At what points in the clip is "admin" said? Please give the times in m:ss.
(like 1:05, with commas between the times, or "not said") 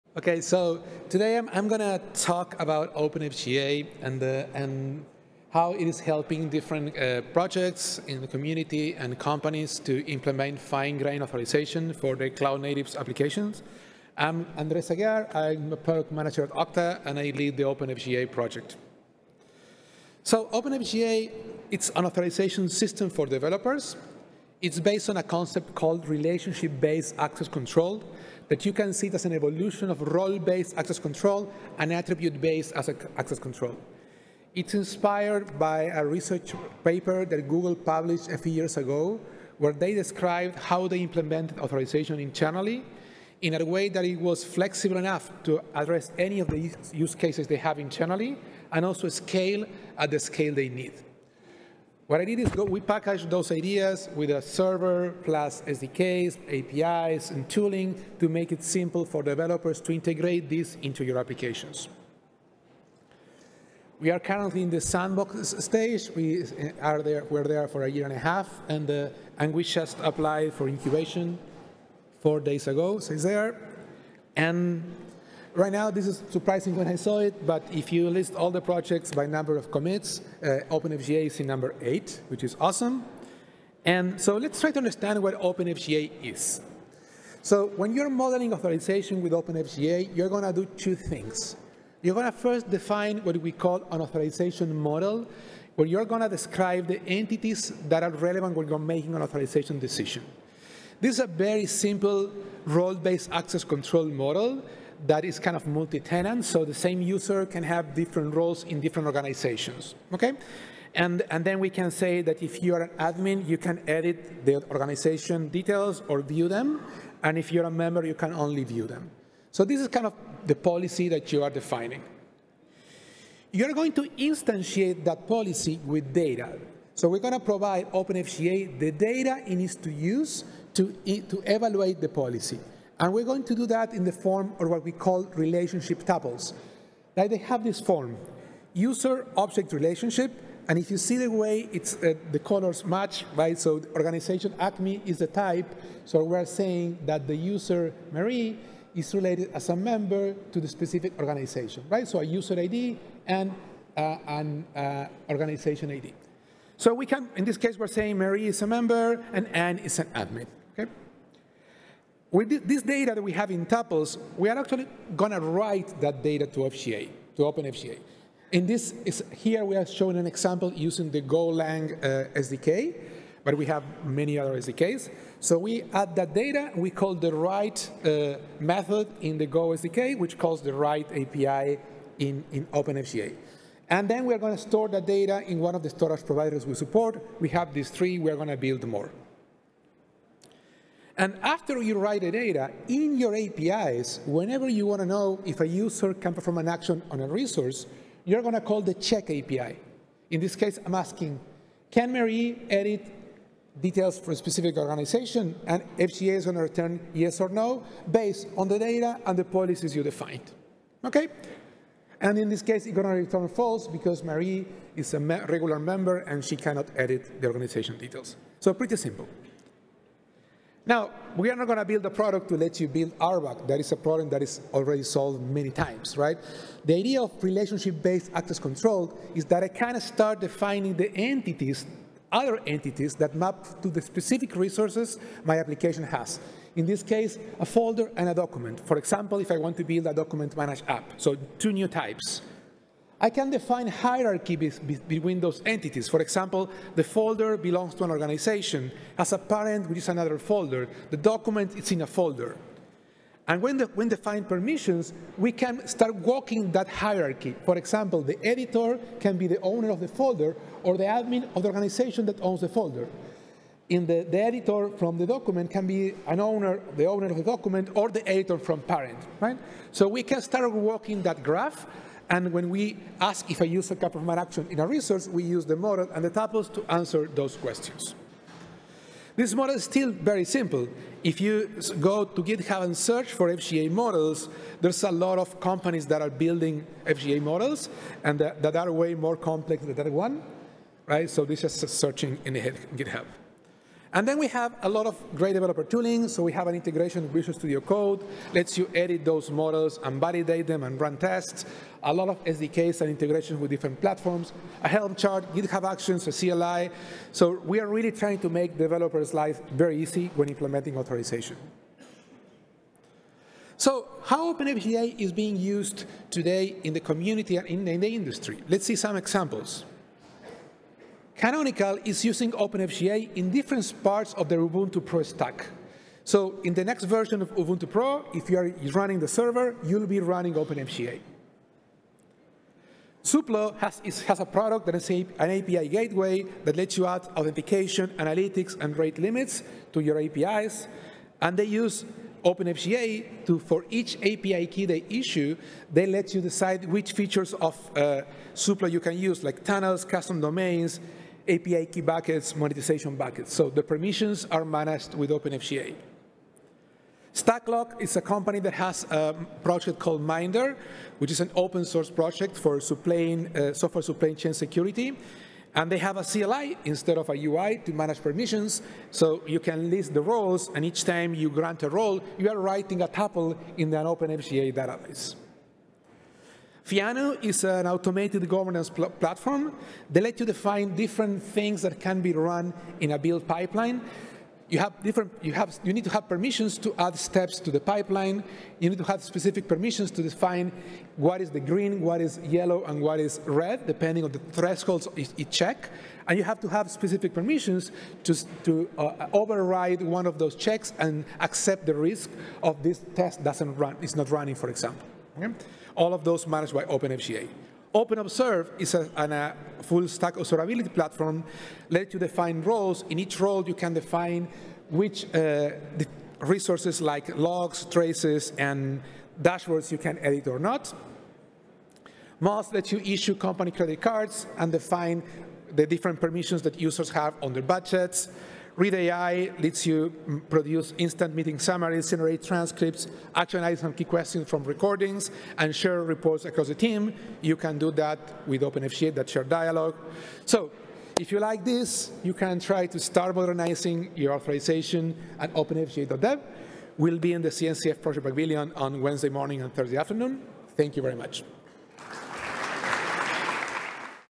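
1:52, 2:40, 4:21.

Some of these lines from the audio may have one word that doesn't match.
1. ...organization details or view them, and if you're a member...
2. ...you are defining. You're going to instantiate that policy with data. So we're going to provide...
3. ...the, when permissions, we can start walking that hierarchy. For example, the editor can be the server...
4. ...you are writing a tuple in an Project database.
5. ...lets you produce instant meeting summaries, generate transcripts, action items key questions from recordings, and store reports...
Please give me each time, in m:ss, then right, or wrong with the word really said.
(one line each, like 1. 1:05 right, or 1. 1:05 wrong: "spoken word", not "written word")
1. 1:54 right
2. 2:01 right
3. 4:13 wrong: "owner", not "server"
4. 6:12 wrong: "OpenFGA", not "Project"
5. 7:09 wrong: "share", not "store".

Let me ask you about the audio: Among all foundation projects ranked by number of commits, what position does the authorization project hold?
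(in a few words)
8.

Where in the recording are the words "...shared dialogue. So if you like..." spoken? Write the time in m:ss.
7:19.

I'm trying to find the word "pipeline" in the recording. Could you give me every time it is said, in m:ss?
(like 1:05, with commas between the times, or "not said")
6:23, 6:27.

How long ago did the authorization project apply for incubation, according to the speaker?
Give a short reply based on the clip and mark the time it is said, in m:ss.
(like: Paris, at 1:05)
4 days, at 1:12.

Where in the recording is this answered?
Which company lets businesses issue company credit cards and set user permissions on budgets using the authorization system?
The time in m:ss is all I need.
7:02.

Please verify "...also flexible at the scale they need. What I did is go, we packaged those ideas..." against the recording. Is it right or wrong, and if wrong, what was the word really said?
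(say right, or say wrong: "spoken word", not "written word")
wrong: "scale", not "flexible".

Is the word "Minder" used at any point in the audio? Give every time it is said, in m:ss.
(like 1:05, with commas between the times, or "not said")
6:00.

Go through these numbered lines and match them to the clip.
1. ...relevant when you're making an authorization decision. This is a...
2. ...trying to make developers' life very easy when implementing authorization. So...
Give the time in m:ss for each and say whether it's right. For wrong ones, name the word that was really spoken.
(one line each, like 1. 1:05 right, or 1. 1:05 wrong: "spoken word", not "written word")
1. 1:38 right
2. 5:08 right.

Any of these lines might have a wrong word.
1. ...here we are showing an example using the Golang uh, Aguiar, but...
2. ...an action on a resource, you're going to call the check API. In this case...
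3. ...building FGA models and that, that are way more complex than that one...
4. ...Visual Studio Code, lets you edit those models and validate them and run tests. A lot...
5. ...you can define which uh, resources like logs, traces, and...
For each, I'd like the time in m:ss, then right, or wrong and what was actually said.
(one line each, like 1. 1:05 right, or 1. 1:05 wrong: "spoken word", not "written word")
1. 2:49 wrong: "SDK", not "Aguiar"
2. 3:16 right
3. 4:46 right
4. 4:57 right
5. 6:53 right.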